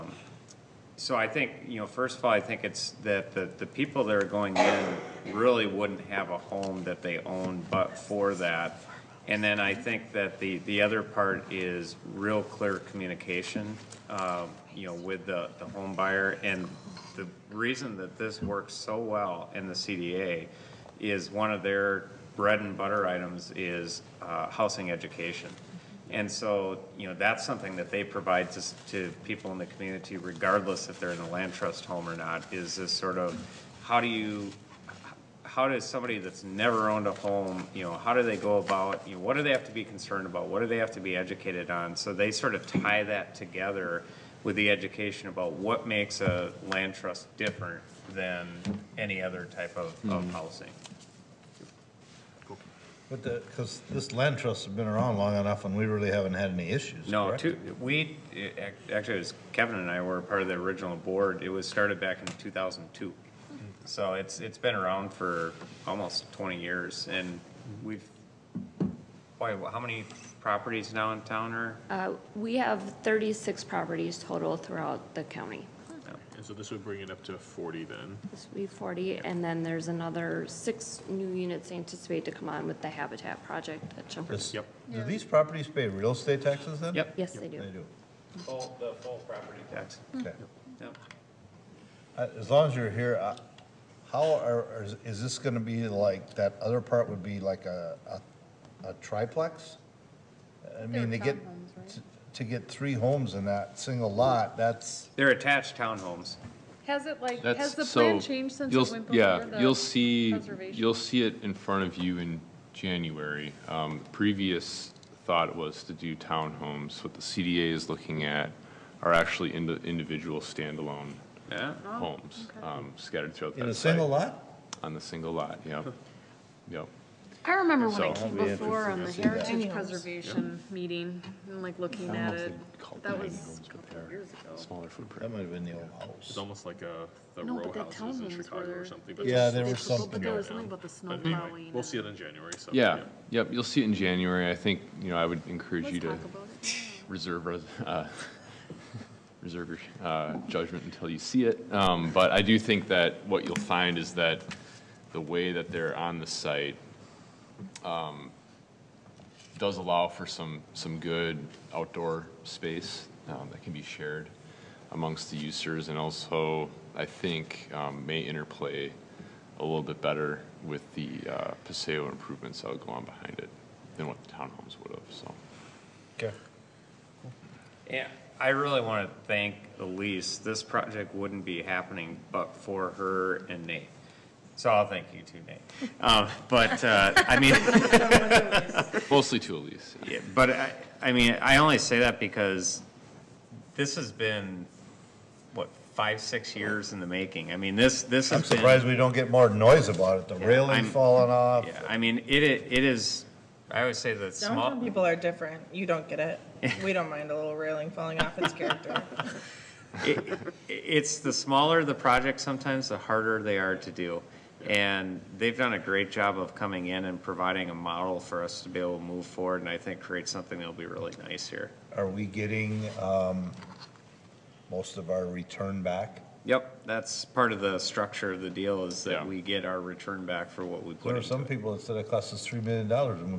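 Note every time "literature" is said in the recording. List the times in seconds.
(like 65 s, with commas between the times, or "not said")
not said.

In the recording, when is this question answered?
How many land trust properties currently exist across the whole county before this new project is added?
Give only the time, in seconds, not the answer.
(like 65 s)
73 s.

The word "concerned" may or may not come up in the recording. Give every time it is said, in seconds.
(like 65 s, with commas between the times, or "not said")
39 s.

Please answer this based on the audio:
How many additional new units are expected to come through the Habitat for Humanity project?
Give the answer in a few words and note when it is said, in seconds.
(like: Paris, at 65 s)
6, at 80 s.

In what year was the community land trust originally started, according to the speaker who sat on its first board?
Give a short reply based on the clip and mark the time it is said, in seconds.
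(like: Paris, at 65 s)
2002, at 62 s.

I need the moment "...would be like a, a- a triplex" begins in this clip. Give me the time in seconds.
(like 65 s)
97 s.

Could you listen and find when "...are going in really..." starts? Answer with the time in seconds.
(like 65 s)
4 s.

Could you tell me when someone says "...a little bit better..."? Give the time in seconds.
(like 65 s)
169 s.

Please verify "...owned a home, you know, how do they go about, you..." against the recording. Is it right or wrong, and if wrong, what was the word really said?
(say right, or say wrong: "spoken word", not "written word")
right.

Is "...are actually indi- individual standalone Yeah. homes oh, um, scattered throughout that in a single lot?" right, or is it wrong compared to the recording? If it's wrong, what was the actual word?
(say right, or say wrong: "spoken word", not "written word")
right.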